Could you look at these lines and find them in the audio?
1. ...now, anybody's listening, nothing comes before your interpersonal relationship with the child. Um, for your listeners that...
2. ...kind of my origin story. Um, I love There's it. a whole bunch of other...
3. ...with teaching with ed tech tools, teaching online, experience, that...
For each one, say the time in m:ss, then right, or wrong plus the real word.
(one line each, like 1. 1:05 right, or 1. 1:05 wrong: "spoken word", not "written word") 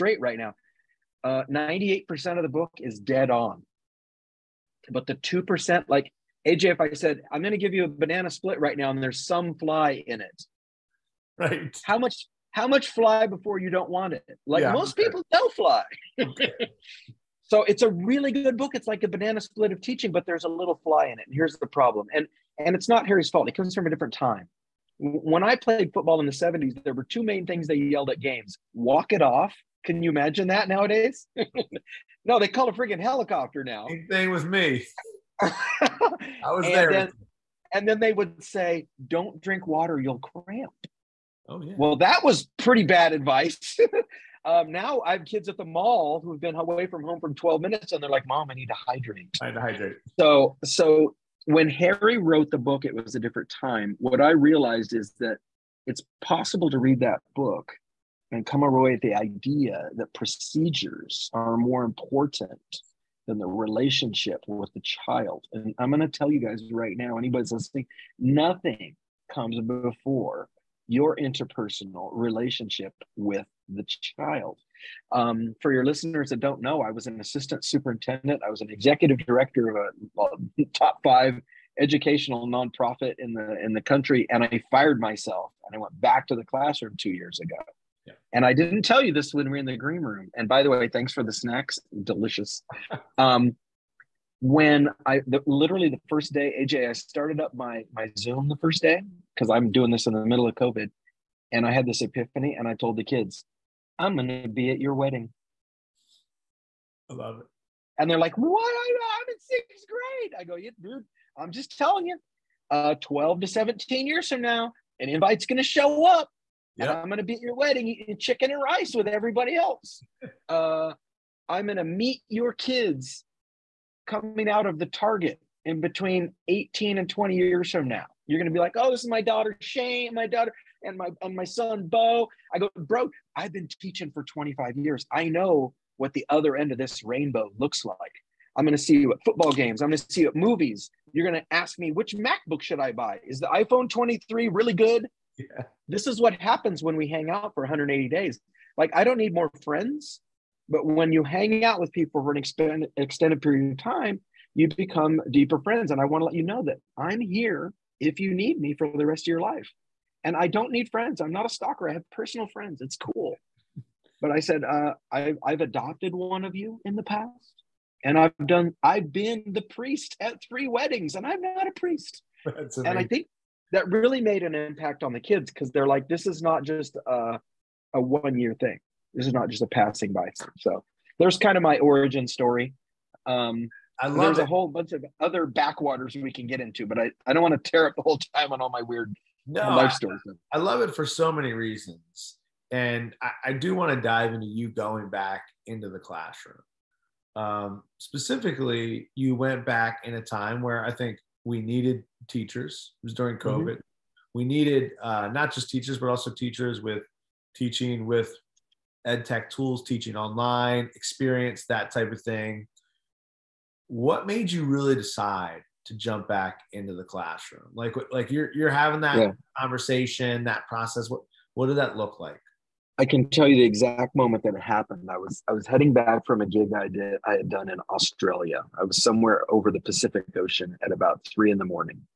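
1. 1:06 right
2. 3:01 right
3. 3:26 right.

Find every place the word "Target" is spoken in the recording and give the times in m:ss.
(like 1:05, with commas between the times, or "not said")
2:04.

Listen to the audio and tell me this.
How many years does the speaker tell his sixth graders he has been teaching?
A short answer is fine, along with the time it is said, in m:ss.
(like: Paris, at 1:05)
25, at 2:14.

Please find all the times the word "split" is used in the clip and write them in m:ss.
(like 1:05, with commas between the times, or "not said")
0:08, 0:19.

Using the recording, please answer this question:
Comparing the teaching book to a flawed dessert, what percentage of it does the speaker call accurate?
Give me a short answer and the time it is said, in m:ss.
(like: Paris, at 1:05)
98%, at 0:01.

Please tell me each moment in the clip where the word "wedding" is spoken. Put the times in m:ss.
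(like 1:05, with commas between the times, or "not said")
1:44, 1:57, 2:50.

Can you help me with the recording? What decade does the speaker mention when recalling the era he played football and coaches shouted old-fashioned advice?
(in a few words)
the 70s.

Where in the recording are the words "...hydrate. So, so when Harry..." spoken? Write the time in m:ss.
0:49.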